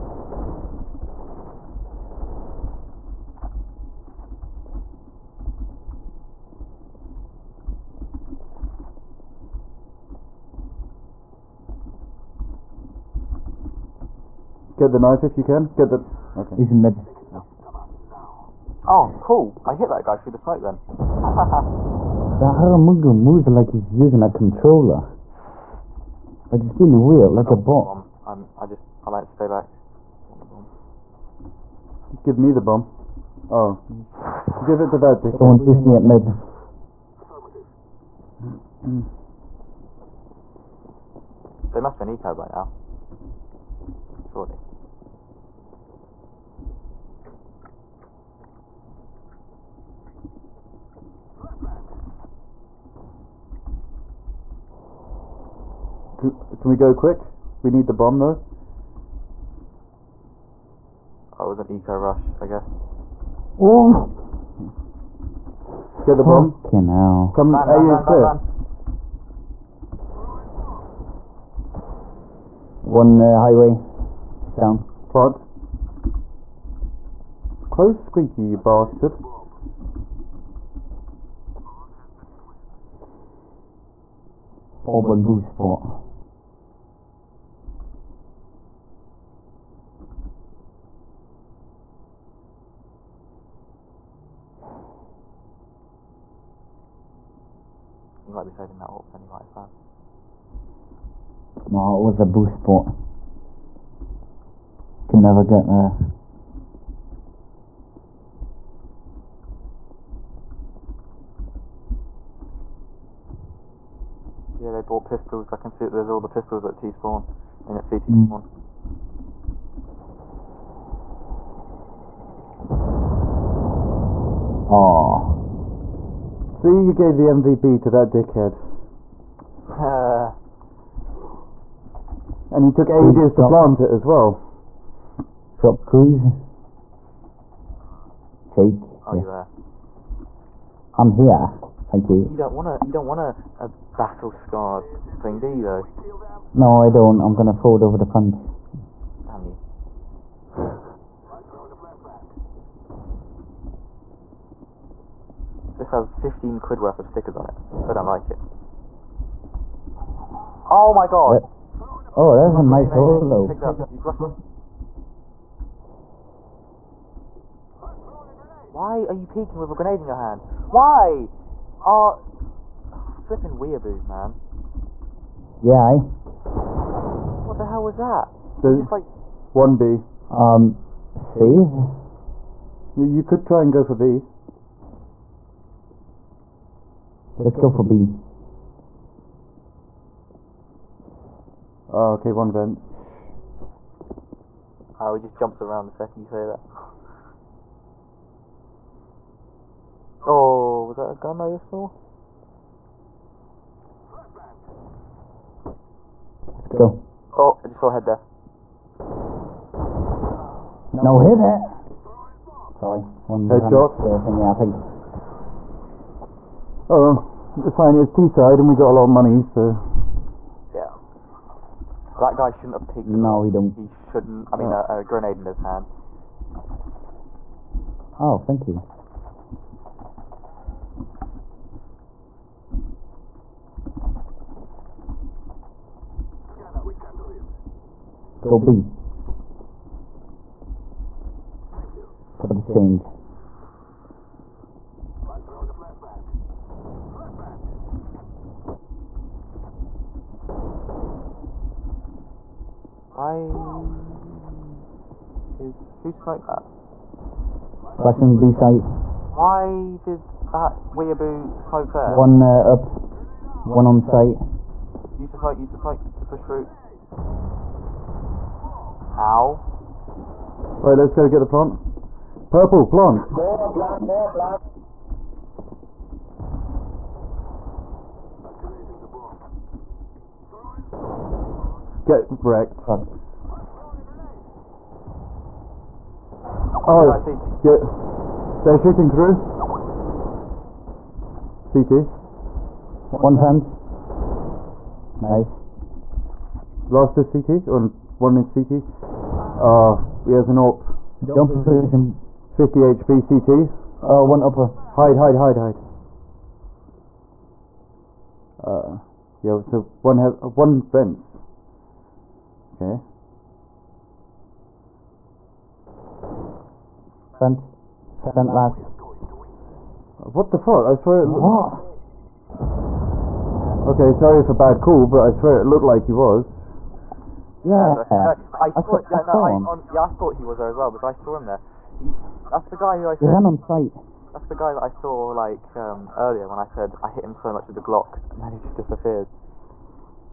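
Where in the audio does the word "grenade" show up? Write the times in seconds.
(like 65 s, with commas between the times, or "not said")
169 s, 225 s.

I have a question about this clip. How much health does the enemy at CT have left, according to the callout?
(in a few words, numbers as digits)
50 HP.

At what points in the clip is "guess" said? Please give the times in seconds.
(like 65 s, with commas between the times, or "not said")
62 s.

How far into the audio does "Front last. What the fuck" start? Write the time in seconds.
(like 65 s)
318 s.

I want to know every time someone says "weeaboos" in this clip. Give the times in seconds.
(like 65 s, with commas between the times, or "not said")
173 s, 260 s.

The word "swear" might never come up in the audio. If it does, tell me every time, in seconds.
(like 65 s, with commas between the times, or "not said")
320 s, 325 s.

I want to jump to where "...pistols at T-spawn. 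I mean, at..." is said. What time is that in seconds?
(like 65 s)
116 s.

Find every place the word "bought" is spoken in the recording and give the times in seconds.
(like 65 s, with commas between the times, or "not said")
114 s.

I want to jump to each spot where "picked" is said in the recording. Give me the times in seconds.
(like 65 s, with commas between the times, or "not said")
163 s, 222 s.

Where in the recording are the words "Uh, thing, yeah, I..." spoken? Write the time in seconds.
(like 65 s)
214 s.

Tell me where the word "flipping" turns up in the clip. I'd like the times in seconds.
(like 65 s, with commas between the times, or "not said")
172 s.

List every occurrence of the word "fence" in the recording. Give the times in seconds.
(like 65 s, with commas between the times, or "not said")
148 s, 293 s.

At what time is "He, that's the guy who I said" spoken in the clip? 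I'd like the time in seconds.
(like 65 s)
331 s.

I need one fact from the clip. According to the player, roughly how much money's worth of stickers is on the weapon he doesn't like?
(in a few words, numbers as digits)
15 quid.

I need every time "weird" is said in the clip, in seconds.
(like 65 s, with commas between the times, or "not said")
26 s.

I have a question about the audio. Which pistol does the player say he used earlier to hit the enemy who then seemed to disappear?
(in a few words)
Glock.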